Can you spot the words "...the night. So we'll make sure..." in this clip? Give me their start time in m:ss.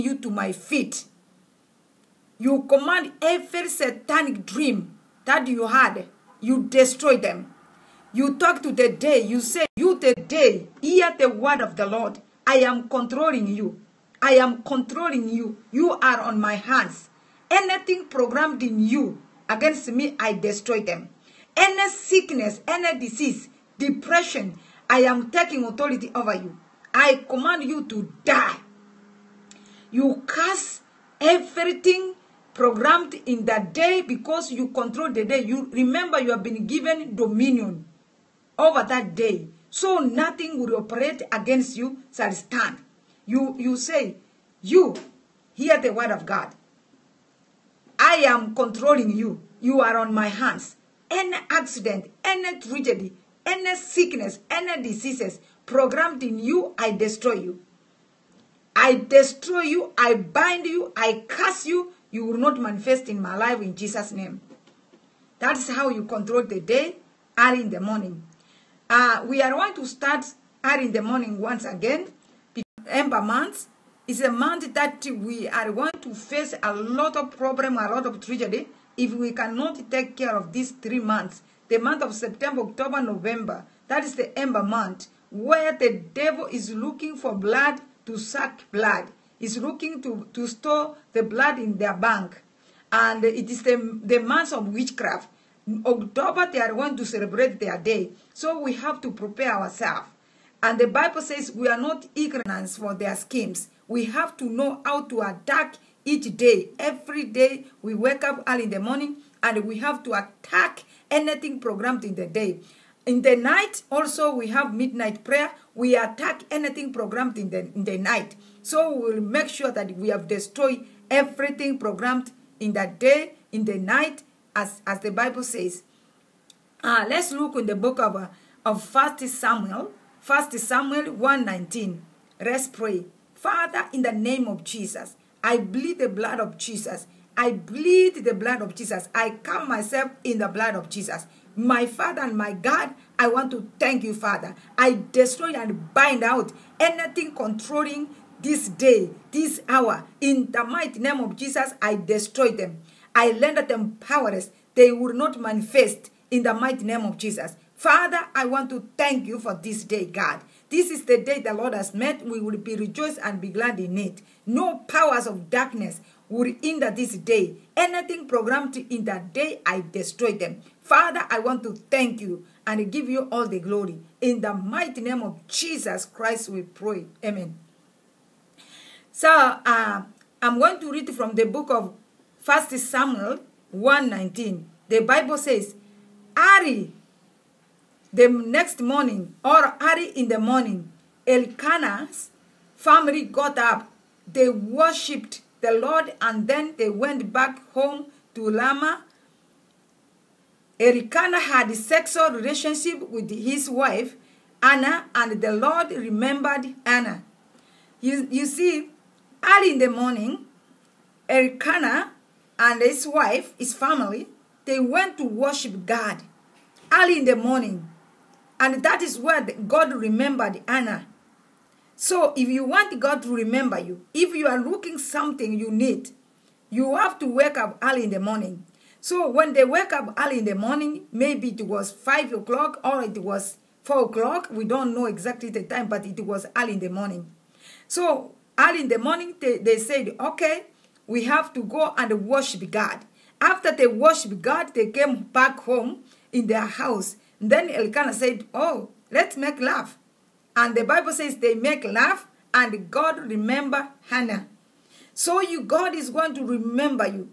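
1:57.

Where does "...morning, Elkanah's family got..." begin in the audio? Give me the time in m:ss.
3:10.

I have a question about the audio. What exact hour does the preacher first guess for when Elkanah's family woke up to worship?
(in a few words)
5 o'clock.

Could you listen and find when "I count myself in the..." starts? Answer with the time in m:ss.
2:19.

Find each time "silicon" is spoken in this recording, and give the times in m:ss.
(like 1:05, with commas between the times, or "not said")
not said.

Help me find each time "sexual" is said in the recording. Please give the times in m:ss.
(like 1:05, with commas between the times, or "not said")
3:21.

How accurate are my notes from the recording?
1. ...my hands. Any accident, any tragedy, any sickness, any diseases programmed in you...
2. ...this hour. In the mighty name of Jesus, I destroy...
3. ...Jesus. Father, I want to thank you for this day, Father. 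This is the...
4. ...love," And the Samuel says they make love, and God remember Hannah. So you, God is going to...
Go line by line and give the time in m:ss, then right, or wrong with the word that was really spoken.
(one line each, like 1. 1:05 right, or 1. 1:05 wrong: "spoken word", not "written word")
1. 0:50 right
2. 2:29 right
3. 2:37 wrong: "God", not "Father"
4. 4:09 wrong: "Bible", not "Samuel".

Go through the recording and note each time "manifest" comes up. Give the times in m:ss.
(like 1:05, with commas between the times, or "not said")
1:02, 2:35.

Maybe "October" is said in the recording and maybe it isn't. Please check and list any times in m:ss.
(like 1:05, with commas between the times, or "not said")
1:22, 1:35.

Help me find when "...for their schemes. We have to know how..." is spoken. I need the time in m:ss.
1:42.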